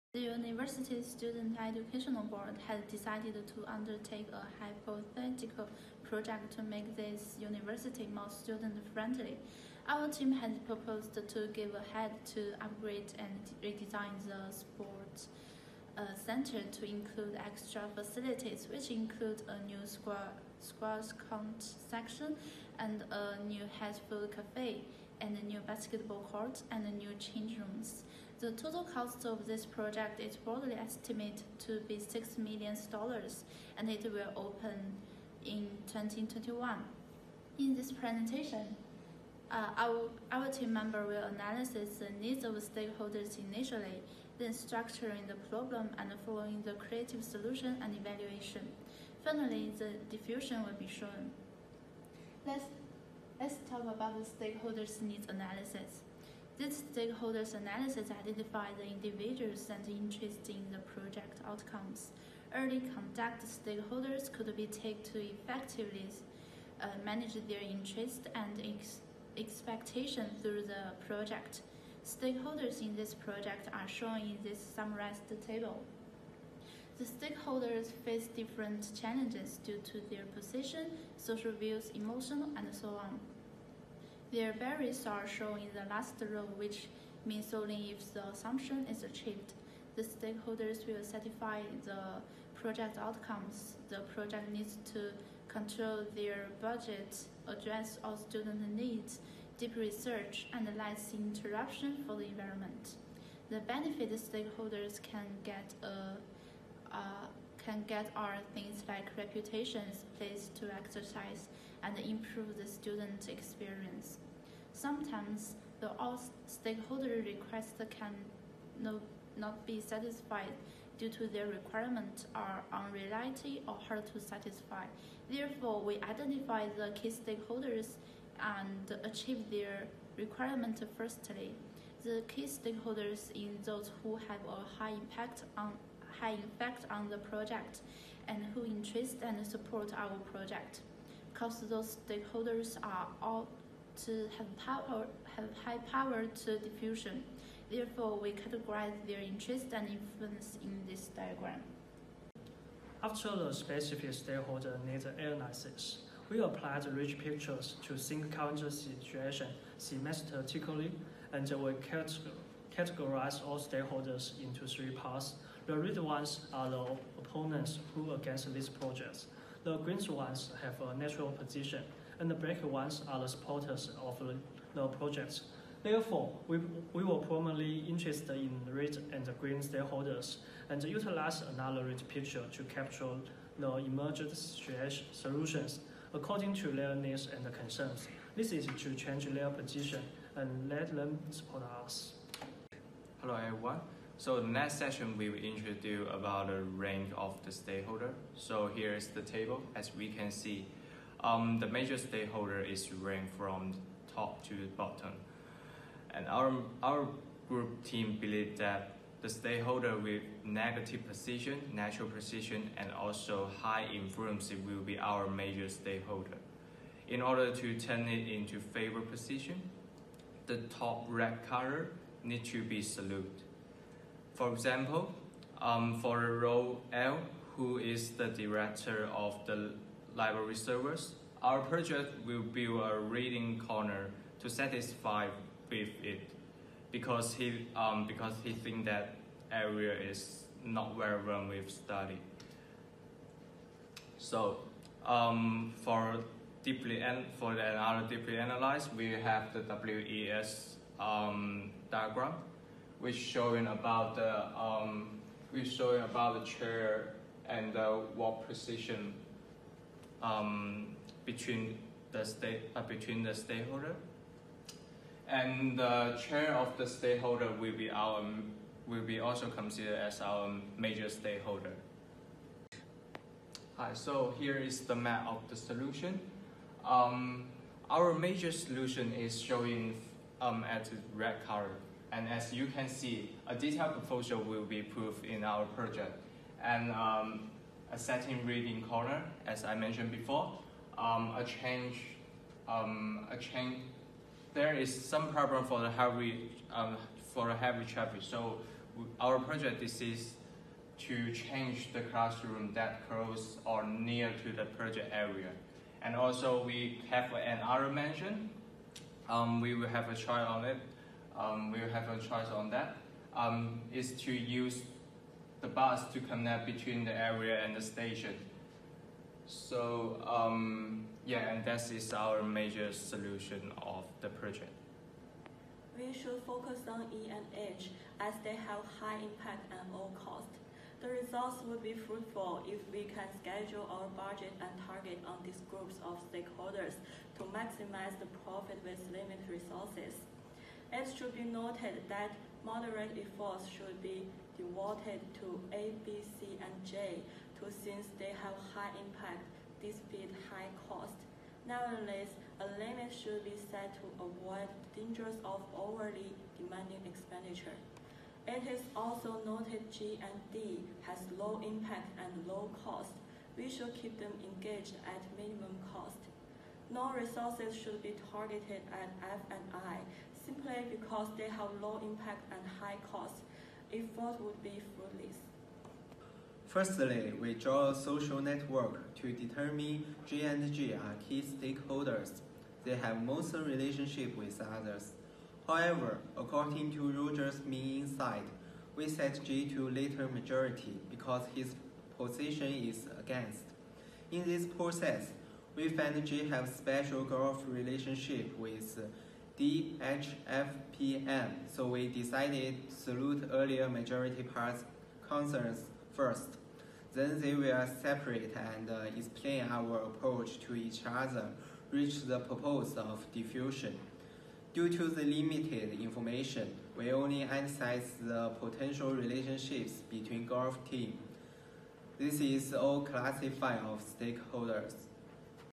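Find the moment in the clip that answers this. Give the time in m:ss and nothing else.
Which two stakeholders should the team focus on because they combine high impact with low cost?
5:27.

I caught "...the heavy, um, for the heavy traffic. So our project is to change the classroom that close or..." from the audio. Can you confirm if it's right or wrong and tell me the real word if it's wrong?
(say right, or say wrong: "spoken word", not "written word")
right.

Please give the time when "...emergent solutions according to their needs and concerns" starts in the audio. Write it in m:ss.
3:03.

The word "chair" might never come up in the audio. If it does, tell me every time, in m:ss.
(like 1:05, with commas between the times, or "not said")
4:16, 4:26.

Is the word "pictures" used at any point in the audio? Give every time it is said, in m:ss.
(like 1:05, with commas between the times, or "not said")
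2:37, 3:02.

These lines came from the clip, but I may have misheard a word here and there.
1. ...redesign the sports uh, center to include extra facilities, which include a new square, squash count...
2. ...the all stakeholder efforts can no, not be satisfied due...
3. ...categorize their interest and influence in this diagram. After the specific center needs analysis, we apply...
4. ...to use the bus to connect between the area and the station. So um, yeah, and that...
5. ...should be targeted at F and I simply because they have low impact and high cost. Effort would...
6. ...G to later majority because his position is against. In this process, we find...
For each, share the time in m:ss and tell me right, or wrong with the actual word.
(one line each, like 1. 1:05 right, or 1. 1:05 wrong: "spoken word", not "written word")
1. 0:13 right
2. 1:55 wrong: "requests", not "efforts"
3. 2:28 wrong: "stakeholder", not "center"
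4. 5:14 right
5. 6:07 right
6. 6:29 right.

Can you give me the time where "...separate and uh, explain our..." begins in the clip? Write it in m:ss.
6:48.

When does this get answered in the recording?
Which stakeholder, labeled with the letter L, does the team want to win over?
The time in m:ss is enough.
3:48.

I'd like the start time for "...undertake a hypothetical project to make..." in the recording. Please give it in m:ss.
0:03.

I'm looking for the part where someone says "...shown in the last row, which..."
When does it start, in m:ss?
1:25.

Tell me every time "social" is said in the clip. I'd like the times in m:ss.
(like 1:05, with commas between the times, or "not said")
1:21, 6:17.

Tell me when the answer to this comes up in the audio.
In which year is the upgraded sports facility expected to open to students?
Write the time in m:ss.
0:35.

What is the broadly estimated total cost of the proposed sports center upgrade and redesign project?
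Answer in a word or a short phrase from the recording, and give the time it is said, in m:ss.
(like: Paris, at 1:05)
$6 million, at 0:31.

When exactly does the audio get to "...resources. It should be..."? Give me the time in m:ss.
5:39.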